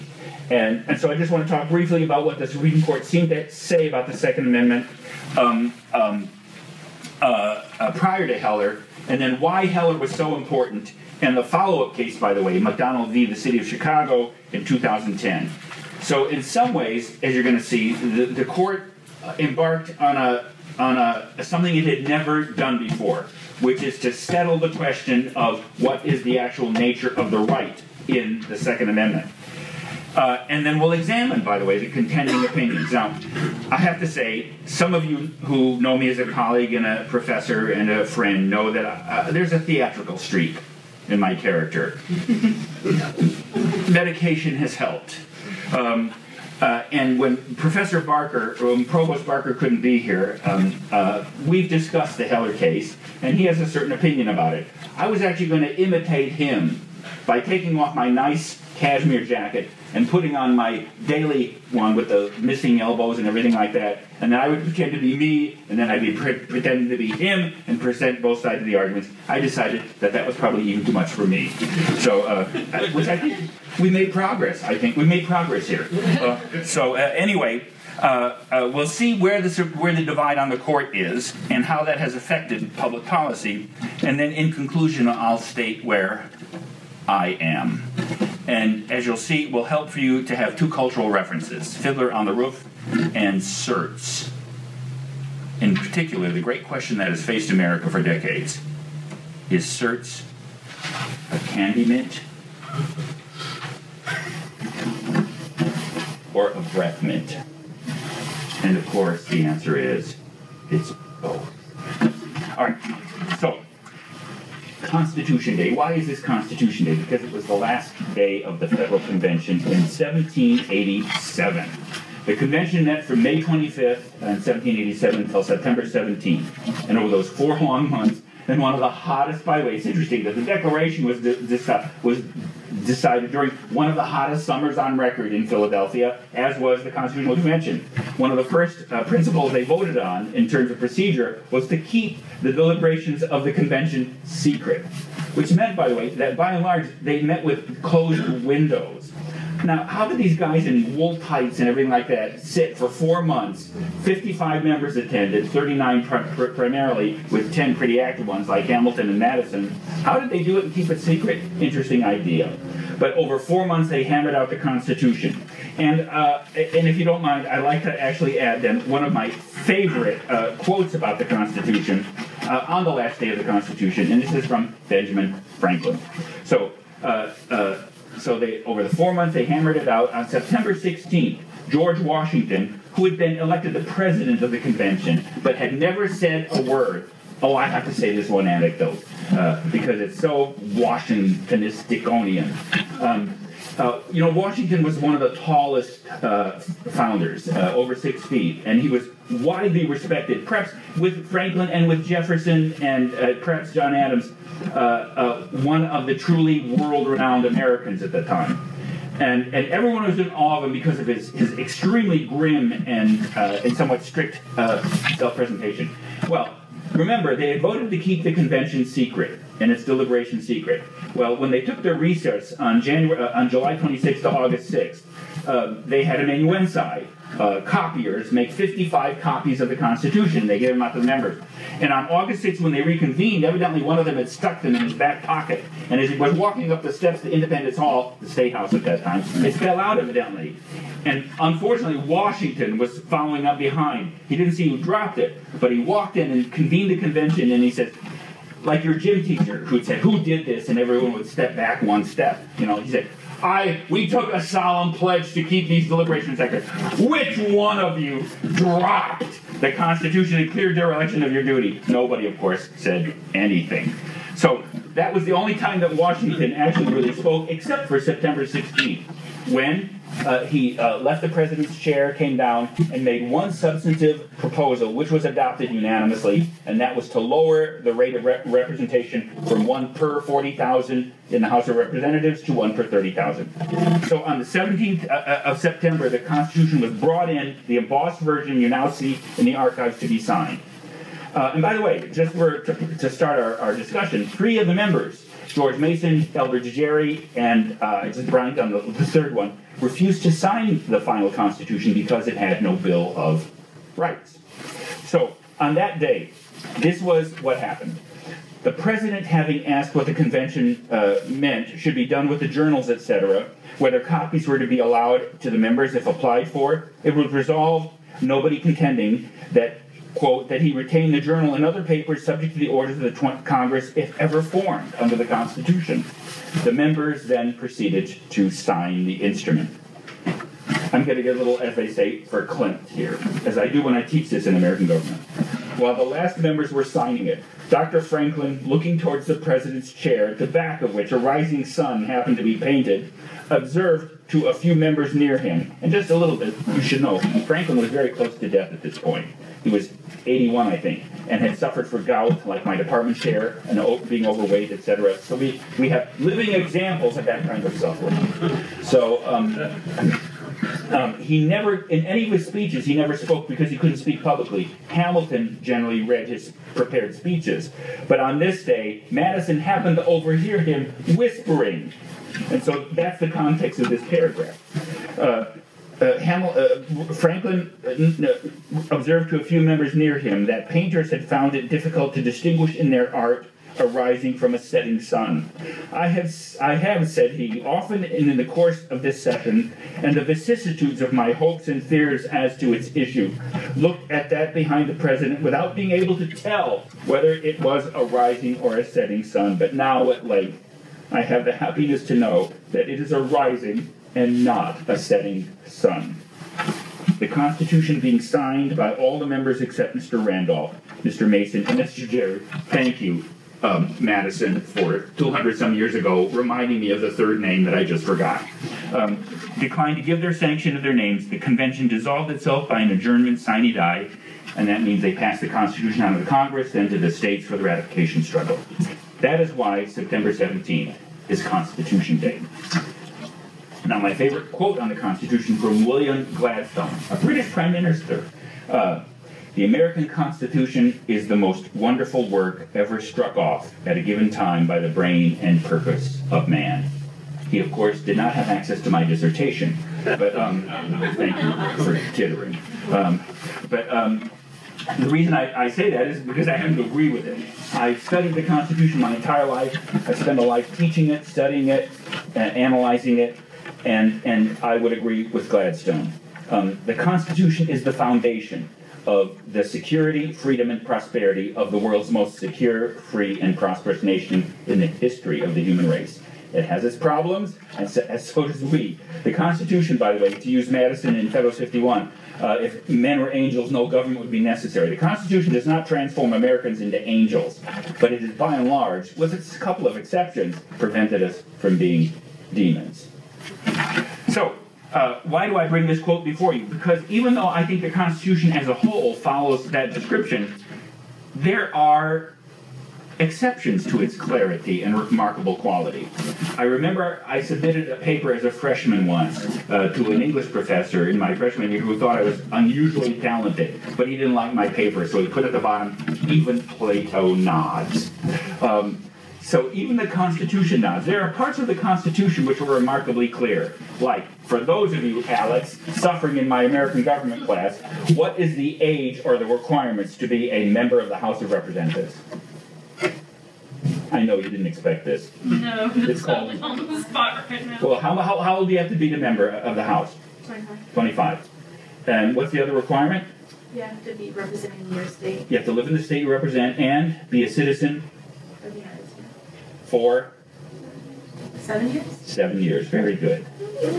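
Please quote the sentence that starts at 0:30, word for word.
Uh, and then we'll examine, by the way, the contending opinions.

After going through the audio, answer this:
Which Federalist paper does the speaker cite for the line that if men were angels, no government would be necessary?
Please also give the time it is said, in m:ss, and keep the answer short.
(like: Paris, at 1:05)
Federalist 51, at 8:01.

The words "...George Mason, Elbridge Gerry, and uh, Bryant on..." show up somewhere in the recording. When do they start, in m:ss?
4:55.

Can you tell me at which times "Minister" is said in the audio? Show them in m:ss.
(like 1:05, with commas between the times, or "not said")
7:17.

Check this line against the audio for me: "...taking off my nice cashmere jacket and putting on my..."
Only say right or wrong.
right.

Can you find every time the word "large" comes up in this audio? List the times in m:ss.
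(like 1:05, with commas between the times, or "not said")
2:26, 8:08.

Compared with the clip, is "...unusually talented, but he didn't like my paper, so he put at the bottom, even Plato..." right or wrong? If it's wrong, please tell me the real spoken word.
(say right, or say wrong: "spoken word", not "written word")
right.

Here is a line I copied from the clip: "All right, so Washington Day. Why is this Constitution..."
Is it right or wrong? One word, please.
wrong.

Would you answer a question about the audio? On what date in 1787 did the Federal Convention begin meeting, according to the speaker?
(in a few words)
May 25th.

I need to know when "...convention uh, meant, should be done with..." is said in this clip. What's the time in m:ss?
5:10.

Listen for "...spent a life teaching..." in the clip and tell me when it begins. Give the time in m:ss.
7:40.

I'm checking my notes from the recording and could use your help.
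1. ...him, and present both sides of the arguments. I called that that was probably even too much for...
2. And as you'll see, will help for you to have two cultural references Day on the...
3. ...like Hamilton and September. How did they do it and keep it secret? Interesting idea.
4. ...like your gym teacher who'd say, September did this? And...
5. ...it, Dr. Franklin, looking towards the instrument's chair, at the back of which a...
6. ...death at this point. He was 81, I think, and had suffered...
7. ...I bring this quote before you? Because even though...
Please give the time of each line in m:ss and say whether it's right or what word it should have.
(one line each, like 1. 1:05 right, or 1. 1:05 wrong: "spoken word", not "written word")
1. 1:07 wrong: "decided", not "called"
2. 1:28 wrong: "Fiddler", not "Day"
3. 2:38 wrong: "Madison", not "September"
4. 4:08 wrong: "Who", not "September"
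5. 5:37 wrong: "president", not "instrument"
6. 5:48 right
7. 8:15 right.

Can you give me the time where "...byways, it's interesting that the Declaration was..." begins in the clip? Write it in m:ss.
2:09.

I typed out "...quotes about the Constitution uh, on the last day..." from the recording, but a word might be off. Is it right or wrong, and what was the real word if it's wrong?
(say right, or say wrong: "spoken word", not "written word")
right.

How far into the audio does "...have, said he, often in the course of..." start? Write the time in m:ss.
6:26.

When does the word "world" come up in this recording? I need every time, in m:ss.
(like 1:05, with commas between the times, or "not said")
3:26, 7:51.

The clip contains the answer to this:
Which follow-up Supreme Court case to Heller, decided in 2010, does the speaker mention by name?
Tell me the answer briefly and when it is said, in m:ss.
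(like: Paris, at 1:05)
McDonald v. the City of Chicago, at 0:12.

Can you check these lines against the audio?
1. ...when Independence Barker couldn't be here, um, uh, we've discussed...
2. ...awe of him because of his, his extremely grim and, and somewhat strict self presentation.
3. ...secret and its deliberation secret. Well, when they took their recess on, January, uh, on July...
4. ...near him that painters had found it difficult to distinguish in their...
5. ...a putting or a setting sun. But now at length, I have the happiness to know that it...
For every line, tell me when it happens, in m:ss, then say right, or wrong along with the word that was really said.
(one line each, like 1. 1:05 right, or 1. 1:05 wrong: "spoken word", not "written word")
1. 0:48 wrong: "Provost", not "Independence"
2. 3:30 right
3. 3:38 right
4. 6:19 right
5. 6:37 wrong: "rising", not "putting".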